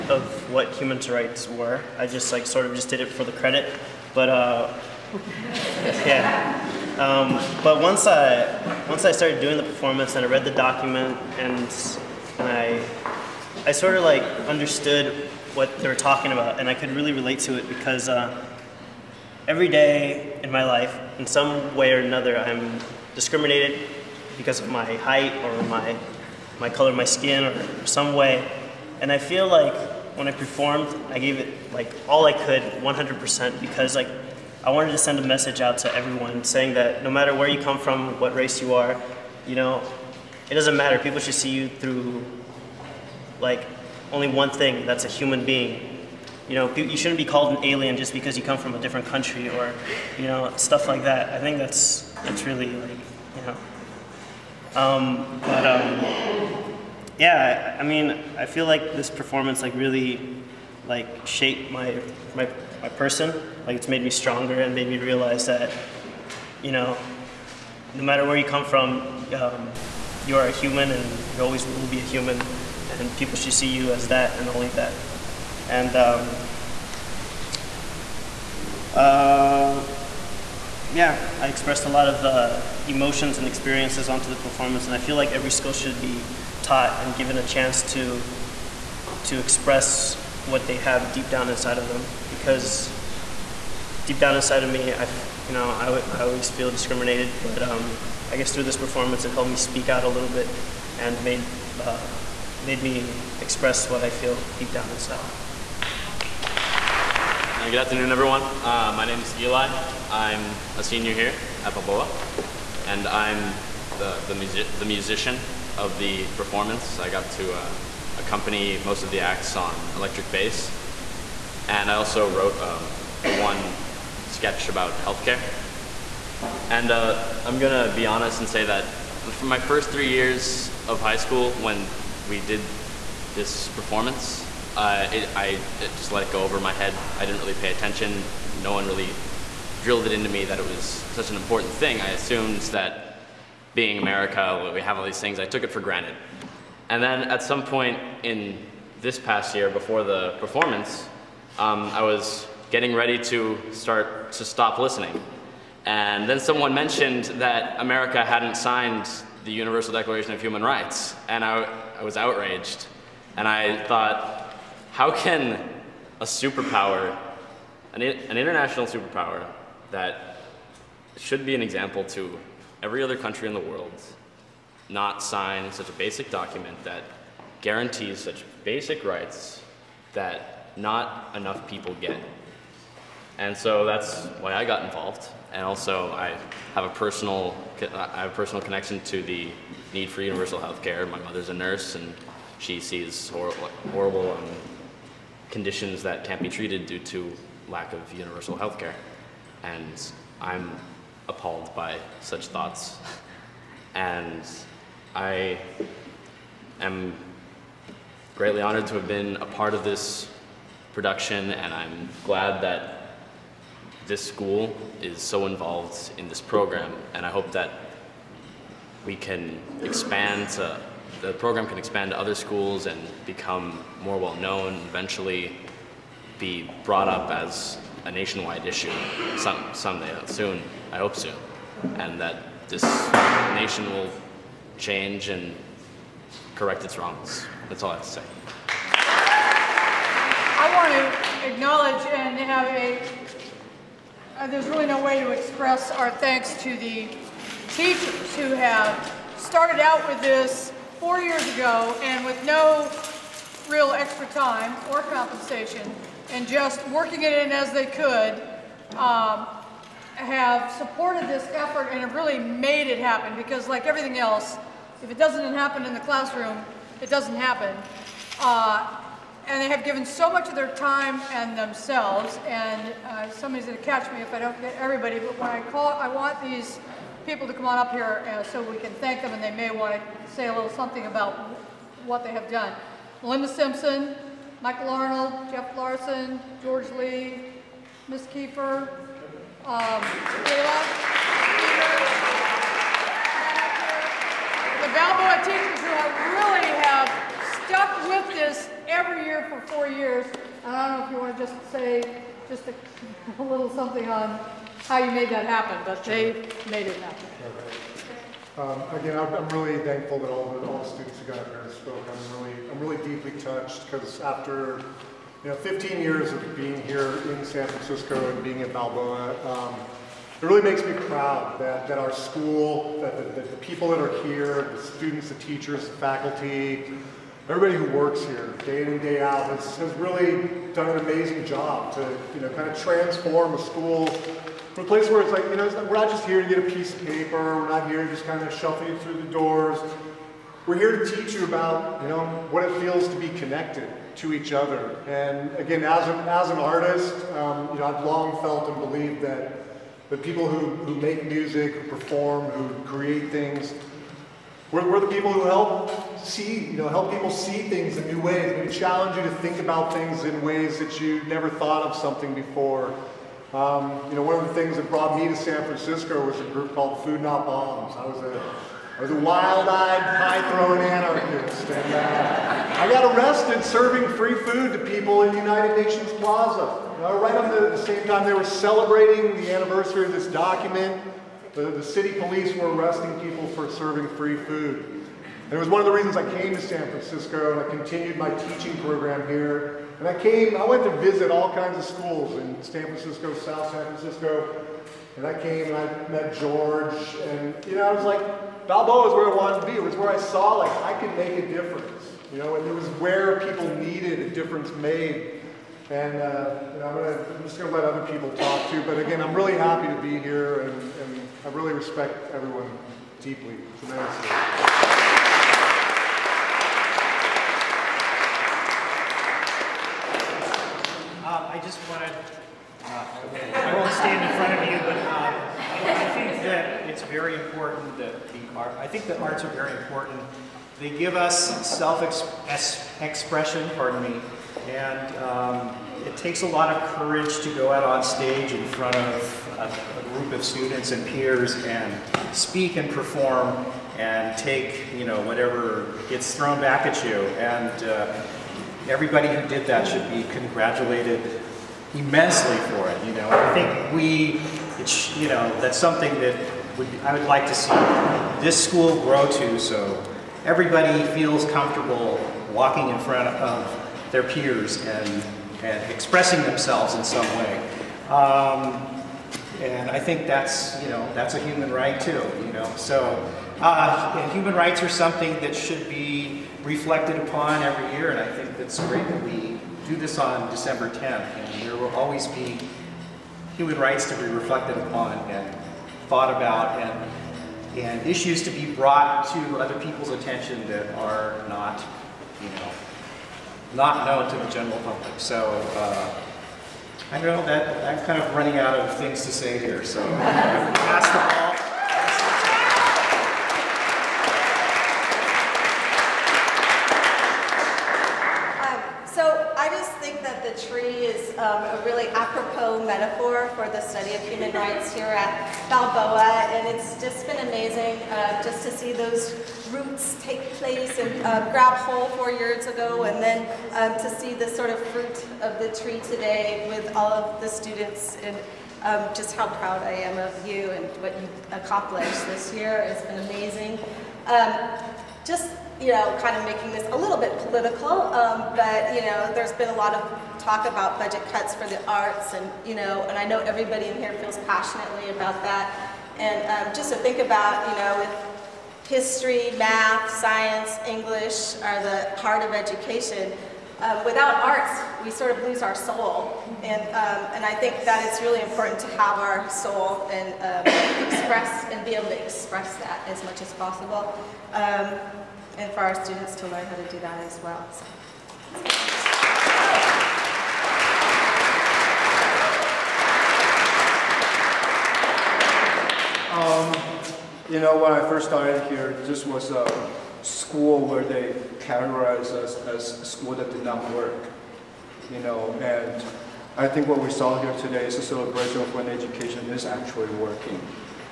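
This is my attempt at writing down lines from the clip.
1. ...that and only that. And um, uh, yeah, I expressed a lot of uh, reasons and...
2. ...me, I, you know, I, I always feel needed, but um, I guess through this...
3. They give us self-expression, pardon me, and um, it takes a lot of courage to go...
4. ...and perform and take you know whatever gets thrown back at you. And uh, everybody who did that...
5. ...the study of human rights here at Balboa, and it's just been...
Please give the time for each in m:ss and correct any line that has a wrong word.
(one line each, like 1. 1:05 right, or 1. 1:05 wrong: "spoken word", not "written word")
1. 1:14 wrong: "emotions", not "reasons"
2. 1:34 wrong: "discriminated", not "needed"
3. 7:10 right
4. 7:22 right
5. 8:33 right.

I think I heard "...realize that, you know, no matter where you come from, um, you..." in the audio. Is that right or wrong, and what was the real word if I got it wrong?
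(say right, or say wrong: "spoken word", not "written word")
right.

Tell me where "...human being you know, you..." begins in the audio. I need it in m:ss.
0:45.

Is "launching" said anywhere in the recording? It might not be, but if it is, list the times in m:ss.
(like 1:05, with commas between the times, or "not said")
not said.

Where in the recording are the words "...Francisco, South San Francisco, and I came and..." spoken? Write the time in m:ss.
6:32.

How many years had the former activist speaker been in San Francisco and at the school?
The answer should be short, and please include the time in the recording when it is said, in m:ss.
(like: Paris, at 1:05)
15, at 5:15.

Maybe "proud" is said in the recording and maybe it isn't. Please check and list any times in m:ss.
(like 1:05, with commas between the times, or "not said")
5:21, 8:49.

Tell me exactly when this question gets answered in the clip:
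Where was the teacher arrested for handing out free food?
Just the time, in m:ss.
6:15.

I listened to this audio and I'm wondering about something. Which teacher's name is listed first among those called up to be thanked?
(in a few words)
Linda Simpson.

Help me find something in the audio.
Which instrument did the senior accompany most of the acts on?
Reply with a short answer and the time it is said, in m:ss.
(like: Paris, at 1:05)
Electric bass, at 1:59.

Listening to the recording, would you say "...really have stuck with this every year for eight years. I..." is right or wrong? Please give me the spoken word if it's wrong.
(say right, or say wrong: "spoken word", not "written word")
wrong: "four", not "eight".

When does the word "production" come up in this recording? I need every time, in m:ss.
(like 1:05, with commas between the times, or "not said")
3:30.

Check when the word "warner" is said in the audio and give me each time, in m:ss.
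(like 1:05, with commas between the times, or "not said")
not said.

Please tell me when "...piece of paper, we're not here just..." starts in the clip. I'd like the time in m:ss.
5:36.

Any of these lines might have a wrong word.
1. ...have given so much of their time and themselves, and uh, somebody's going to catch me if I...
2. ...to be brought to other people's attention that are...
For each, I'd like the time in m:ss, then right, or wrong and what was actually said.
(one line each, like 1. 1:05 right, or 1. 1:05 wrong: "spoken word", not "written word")
1. 4:29 right
2. 8:08 right.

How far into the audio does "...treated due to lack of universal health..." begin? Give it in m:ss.
3:16.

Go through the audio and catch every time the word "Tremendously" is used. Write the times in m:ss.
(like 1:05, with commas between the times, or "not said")
6:53.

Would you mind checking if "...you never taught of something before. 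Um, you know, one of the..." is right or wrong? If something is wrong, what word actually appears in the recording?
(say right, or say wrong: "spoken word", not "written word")
wrong: "thought", not "taught".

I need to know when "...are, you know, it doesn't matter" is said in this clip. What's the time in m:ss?
0:38.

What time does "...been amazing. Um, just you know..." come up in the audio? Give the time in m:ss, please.
8:53.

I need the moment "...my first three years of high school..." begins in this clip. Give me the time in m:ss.
2:09.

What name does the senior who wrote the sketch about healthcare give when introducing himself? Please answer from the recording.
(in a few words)
Eli.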